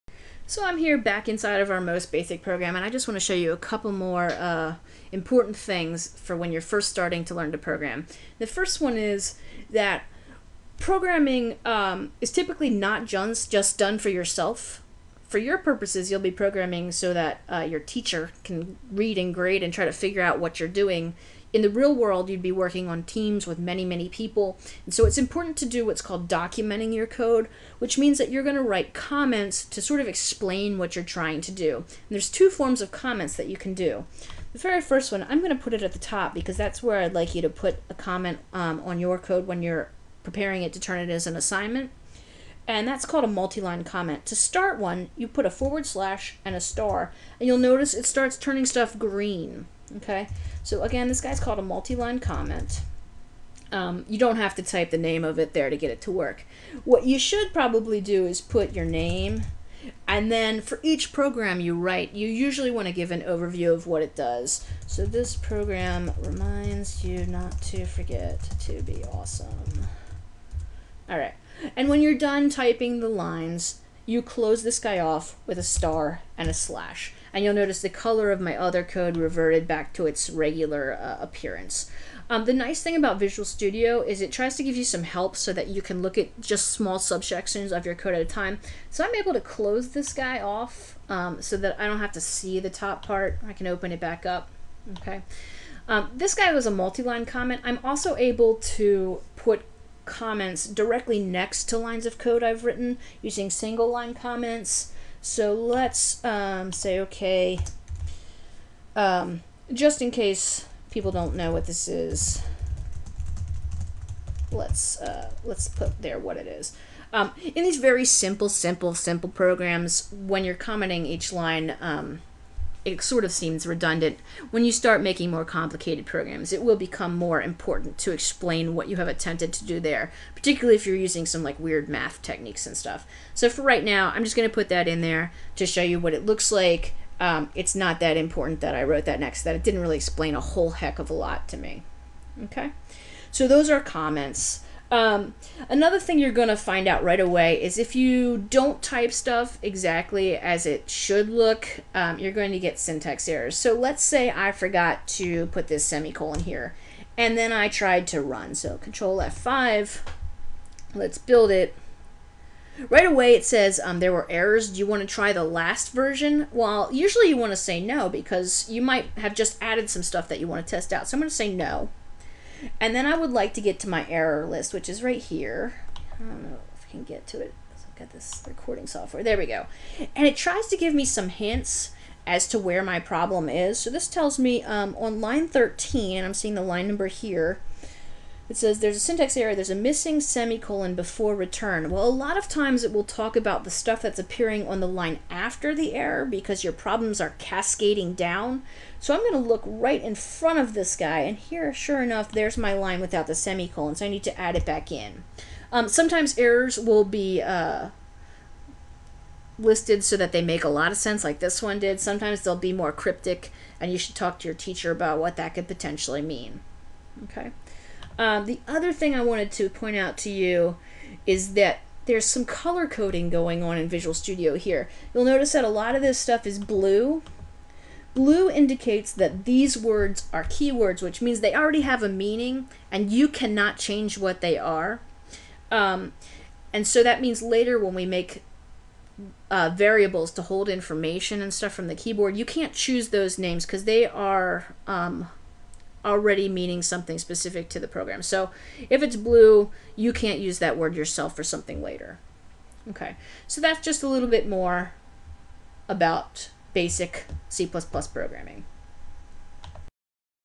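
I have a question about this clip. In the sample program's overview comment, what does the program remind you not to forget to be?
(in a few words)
awesome.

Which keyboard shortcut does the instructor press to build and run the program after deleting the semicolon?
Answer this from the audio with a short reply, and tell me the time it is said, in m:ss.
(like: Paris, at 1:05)
Control F5, at 2:38.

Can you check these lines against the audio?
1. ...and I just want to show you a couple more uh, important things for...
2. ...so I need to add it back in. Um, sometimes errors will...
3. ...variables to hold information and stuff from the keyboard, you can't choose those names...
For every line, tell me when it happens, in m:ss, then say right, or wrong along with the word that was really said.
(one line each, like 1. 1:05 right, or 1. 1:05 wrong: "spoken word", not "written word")
1. 0:02 right
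2. 3:23 right
3. 3:59 right.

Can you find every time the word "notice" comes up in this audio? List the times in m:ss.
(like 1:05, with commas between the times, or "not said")
0:47, 1:17, 3:45.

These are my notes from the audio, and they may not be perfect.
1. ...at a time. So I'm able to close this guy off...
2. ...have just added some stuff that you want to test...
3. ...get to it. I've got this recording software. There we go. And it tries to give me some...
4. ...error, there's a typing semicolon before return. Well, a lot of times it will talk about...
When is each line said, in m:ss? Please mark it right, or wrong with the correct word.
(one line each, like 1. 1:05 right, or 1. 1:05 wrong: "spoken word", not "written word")
1. 1:28 right
2. 2:49 right
3. 2:57 right
4. 3:09 wrong: "missing", not "typing".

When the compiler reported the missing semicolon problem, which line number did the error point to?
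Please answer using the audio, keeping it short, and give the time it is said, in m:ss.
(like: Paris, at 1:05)
13, at 3:05.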